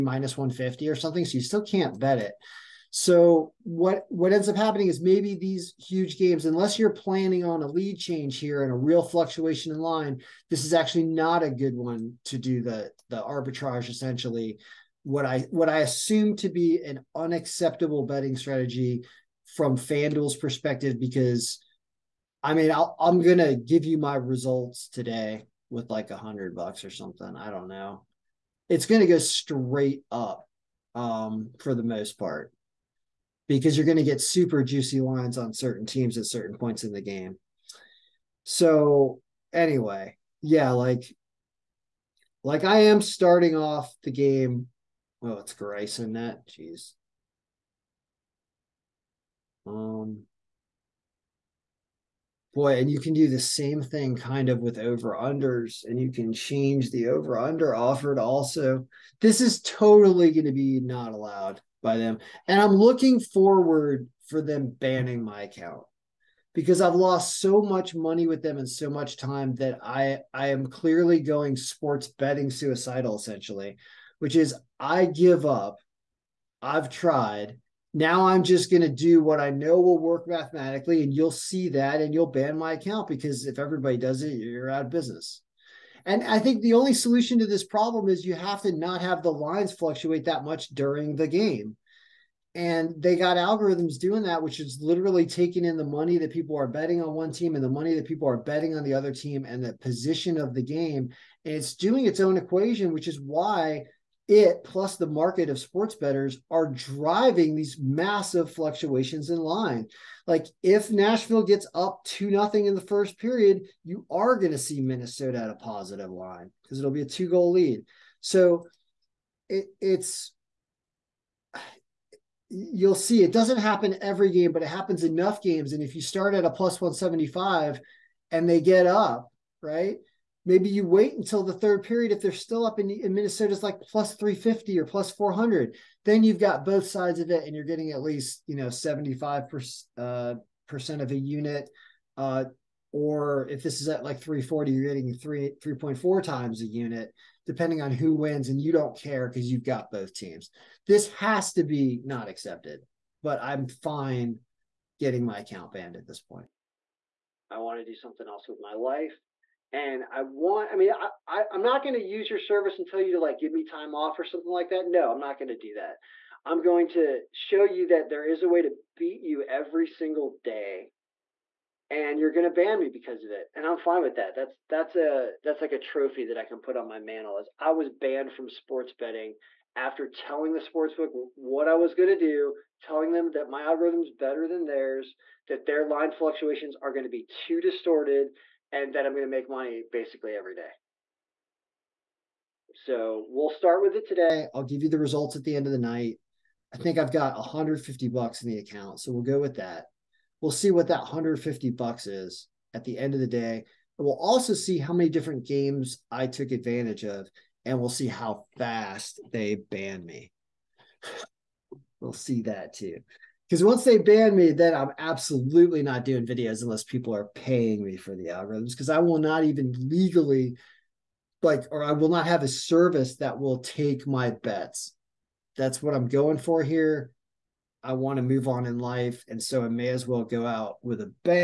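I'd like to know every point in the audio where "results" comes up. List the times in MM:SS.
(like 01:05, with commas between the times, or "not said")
00:24, 03:14.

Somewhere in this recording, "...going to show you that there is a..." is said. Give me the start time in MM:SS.
02:46.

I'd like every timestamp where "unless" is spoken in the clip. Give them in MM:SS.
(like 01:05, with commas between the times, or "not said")
00:06, 03:36.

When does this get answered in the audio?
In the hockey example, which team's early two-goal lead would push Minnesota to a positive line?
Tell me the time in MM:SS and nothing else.
01:50.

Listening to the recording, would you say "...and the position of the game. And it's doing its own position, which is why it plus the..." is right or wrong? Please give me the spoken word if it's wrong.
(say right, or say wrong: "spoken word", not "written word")
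wrong: "equation", not "position".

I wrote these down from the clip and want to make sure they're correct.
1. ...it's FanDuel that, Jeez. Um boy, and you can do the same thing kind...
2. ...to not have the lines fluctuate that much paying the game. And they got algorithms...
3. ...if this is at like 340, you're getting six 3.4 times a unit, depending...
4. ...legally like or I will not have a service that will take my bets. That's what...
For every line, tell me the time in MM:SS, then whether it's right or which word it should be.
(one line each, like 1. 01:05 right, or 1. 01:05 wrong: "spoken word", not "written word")
1. 00:45 wrong: "Grayson", not "FanDuel"
2. 01:28 wrong: "during", not "paying"
3. 02:23 wrong: "three", not "six"
4. 03:39 right.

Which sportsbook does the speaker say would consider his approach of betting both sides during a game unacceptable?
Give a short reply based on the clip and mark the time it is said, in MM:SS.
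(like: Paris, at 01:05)
FanDuel, at 00:19.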